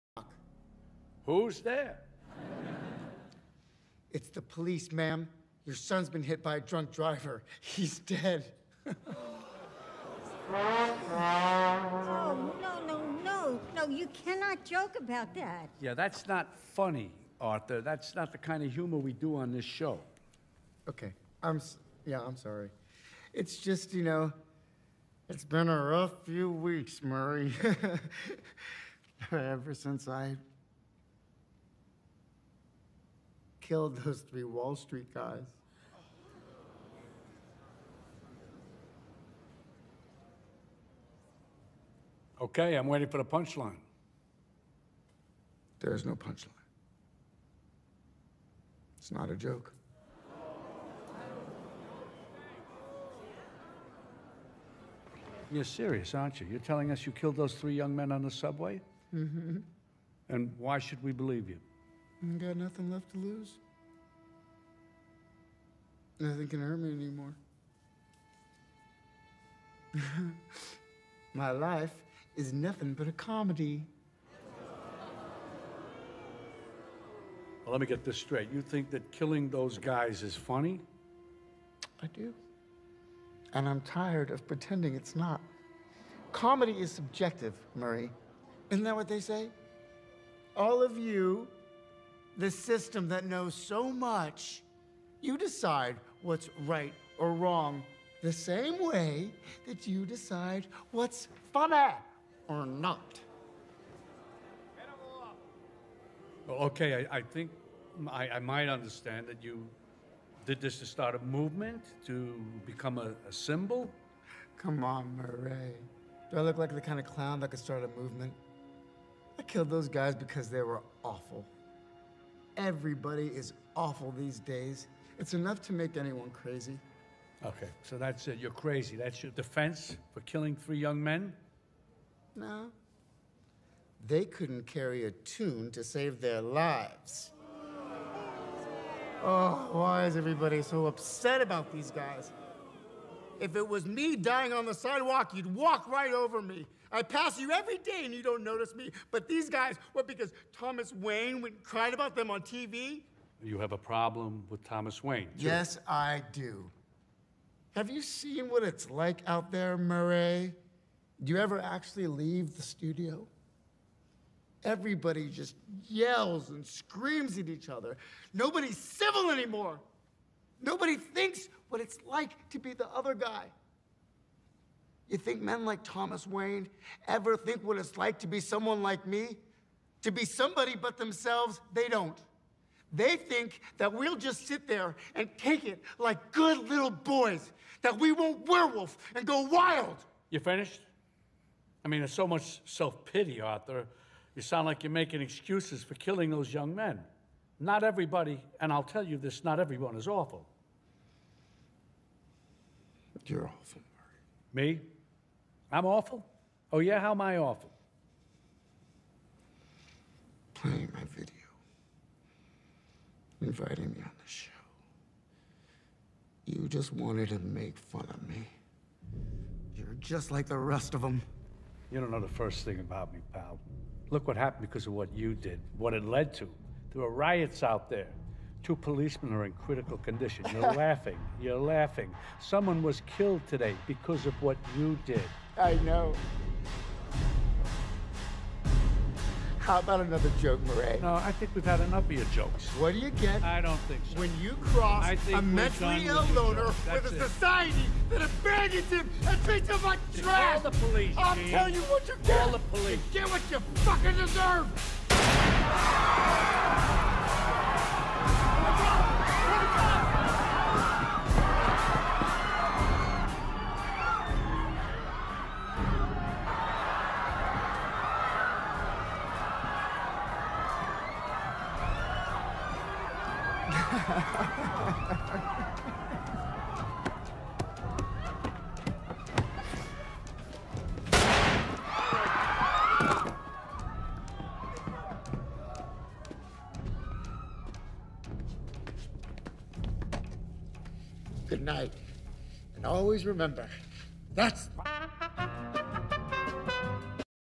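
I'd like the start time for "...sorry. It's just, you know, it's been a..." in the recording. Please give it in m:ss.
0:22.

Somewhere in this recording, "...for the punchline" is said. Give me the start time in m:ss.
0:43.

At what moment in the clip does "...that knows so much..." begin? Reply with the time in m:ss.
1:33.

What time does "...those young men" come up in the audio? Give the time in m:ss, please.
3:16.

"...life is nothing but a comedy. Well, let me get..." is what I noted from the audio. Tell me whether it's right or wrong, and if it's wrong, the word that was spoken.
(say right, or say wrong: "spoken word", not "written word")
right.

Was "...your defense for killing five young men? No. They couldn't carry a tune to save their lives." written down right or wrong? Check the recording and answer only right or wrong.
wrong.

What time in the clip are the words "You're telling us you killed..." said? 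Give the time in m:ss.
0:56.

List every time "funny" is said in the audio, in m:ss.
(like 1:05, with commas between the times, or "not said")
0:16, 1:20, 1:41.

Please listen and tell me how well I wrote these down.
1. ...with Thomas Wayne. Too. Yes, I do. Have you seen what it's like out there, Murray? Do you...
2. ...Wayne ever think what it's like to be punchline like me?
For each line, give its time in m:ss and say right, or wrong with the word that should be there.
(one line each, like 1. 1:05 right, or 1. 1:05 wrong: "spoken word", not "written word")
1. 2:34 right
2. 2:56 wrong: "someone", not "punchline".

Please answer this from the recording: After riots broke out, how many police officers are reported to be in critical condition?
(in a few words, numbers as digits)
2.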